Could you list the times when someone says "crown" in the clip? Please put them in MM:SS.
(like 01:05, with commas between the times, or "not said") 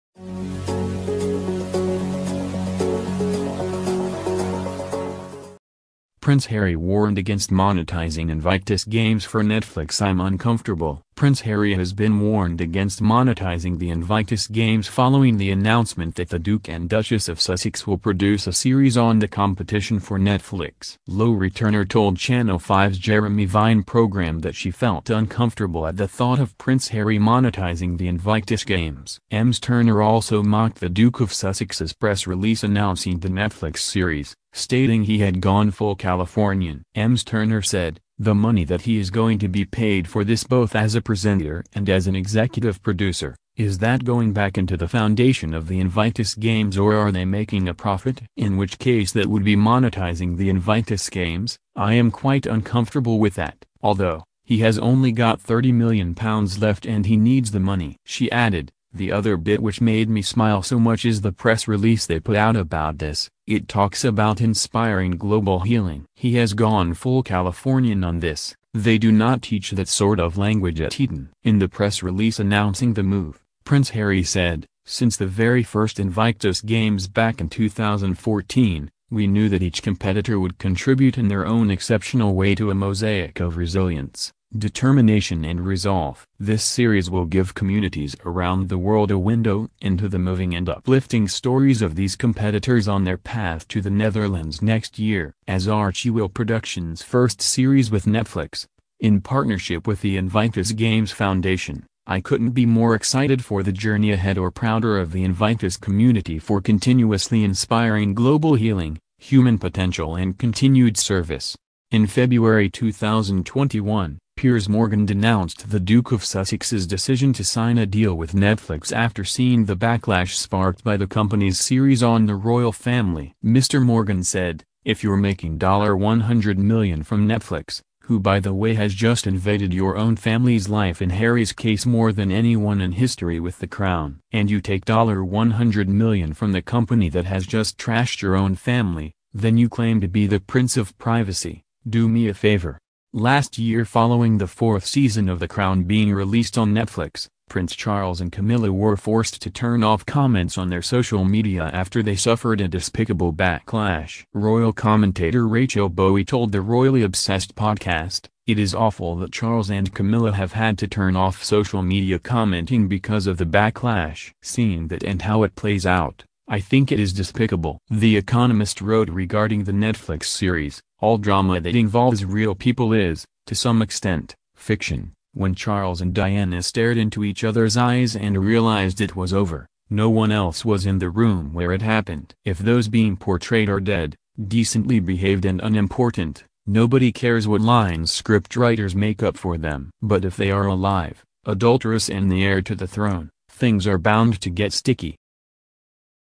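02:13, 02:25.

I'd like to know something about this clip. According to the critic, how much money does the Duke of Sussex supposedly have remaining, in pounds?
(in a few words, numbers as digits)
30 million pounds.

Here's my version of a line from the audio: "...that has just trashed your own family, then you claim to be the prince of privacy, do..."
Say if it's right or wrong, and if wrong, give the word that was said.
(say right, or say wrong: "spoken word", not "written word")
right.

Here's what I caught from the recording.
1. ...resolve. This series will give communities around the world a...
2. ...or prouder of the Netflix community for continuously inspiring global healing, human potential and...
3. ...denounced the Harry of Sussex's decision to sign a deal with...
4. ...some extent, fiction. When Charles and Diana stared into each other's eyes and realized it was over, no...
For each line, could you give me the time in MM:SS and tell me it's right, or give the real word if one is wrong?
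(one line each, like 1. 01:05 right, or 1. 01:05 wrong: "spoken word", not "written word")
1. 01:25 right
2. 01:44 wrong: "Invictus", not "Netflix"
3. 01:55 wrong: "Duke", not "Harry"
4. 02:53 right.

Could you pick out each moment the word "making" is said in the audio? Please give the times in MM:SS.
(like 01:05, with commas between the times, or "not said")
00:47, 02:05.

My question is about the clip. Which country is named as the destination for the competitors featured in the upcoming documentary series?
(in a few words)
the Netherlands.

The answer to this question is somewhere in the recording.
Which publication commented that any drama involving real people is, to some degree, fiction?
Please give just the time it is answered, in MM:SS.
02:47.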